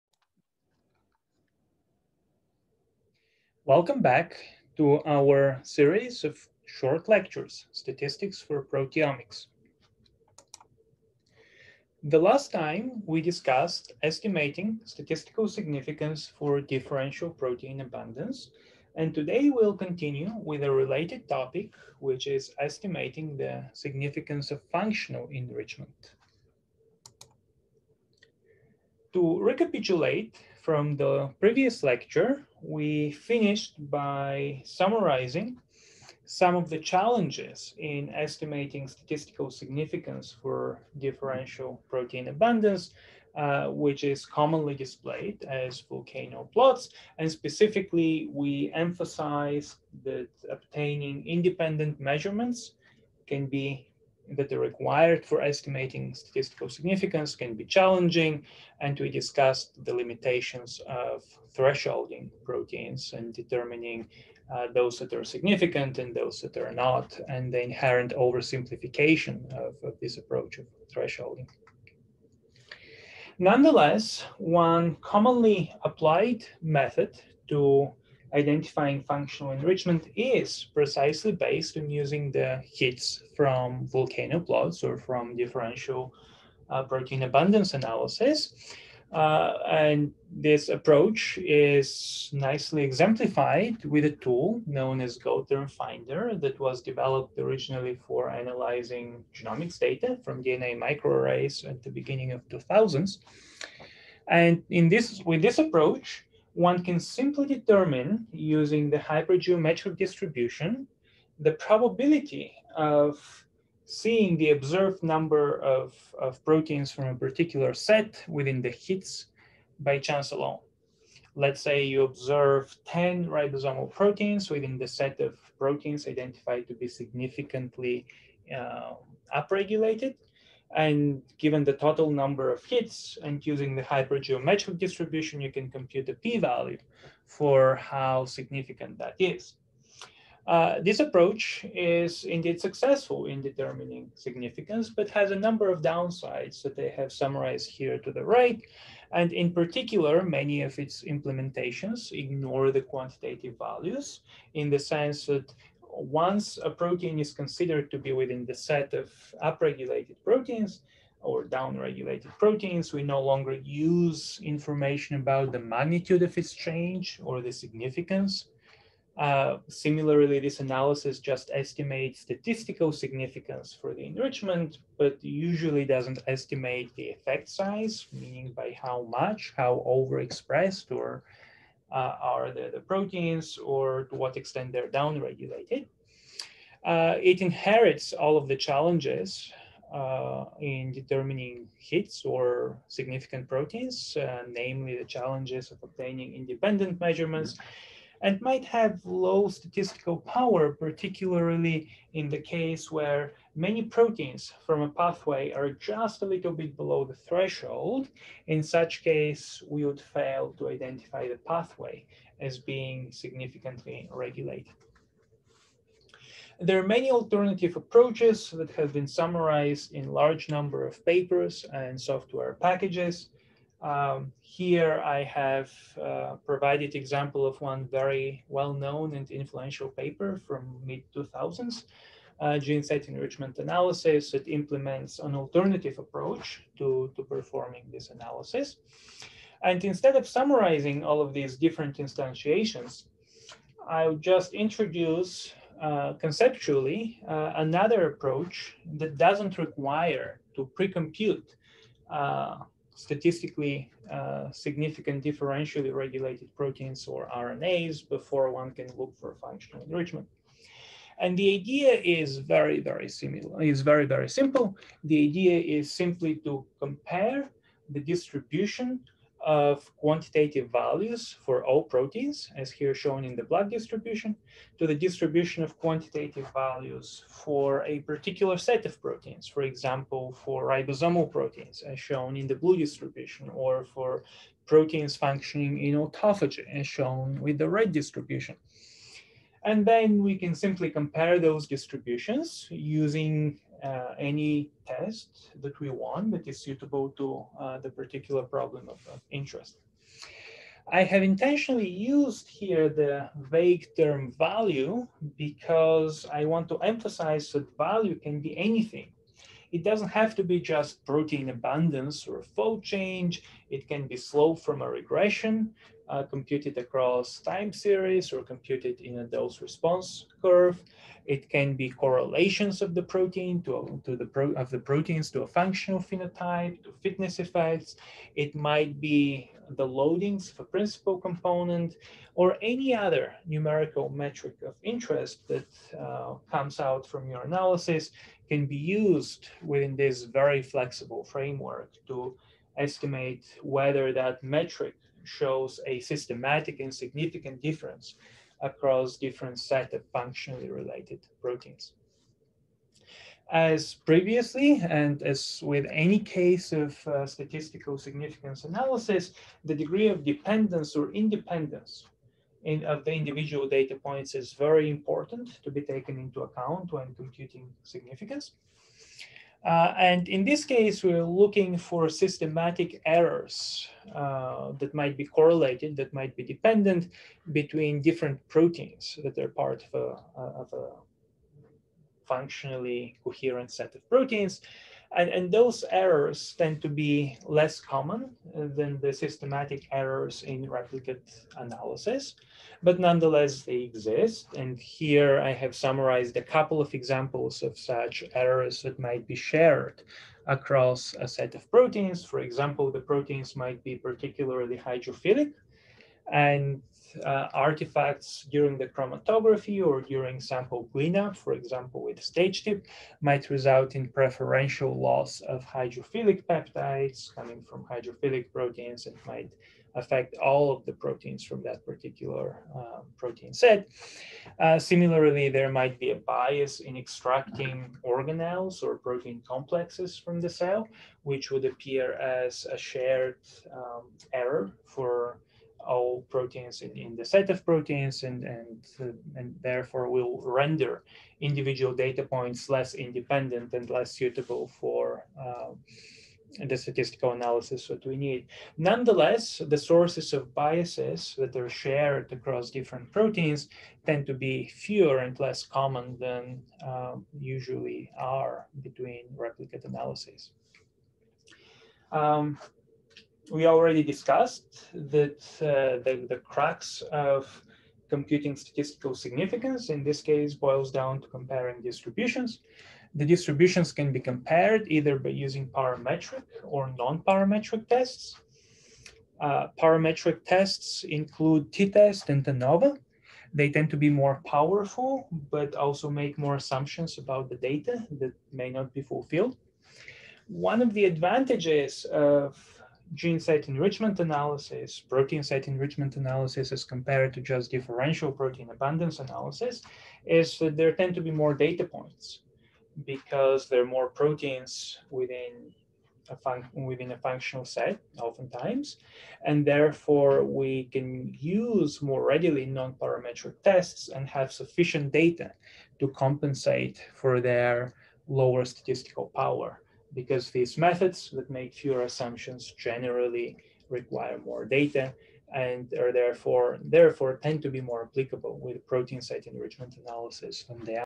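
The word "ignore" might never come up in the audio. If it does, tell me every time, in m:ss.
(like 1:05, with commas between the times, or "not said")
2:32.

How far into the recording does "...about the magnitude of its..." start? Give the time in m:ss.
2:45.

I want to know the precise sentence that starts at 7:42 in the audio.
Um, we already discussed that uh, the, the cracks of computing statistical significance, in this case, boils down to comparing distributions.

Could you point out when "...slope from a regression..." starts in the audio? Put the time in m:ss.
5:14.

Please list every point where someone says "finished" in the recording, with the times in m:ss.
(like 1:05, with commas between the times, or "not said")
0:33.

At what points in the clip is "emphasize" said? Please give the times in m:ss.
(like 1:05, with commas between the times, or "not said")
0:48, 5:06.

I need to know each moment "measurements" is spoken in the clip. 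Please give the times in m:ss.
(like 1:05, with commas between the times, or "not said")
0:51, 3:16.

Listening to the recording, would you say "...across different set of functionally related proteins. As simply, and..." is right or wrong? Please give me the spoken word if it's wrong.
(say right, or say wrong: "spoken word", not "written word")
wrong: "previously", not "simply".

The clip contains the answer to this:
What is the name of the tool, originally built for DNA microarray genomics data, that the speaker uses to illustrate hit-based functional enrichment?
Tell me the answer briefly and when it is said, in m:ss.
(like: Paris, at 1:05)
GO Term Finder, at 1:35.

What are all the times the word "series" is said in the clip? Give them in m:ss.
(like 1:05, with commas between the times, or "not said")
0:05, 5:17.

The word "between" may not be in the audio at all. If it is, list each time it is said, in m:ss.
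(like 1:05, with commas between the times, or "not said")
6:17, 7:38.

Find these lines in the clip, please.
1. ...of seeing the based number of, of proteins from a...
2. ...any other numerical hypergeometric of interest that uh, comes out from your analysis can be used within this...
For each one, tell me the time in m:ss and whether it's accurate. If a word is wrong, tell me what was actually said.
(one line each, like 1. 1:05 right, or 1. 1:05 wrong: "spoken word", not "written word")
1. 1:52 wrong: "observed", not "based"
2. 5:32 wrong: "metric", not "hypergeometric".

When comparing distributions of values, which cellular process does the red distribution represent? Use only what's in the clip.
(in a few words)
autophagy.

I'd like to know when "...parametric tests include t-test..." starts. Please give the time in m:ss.
7:59.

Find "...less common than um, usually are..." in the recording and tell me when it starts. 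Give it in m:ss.
7:35.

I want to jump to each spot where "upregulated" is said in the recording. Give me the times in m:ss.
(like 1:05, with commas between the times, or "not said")
2:09, 2:39.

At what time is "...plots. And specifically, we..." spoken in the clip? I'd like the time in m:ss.
0:46.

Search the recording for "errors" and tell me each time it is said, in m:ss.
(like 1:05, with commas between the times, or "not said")
6:13, 6:25, 6:29, 6:38, 7:14.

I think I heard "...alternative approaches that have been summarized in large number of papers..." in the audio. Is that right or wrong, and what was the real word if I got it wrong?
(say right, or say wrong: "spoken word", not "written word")
right.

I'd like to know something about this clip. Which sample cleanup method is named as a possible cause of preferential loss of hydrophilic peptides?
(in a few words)
stage tip.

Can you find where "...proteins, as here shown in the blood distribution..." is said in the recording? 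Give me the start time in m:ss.
4:31.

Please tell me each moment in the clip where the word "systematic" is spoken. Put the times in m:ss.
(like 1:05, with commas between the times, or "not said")
5:45, 6:12, 6:29.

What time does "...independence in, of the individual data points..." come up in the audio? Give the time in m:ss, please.
6:01.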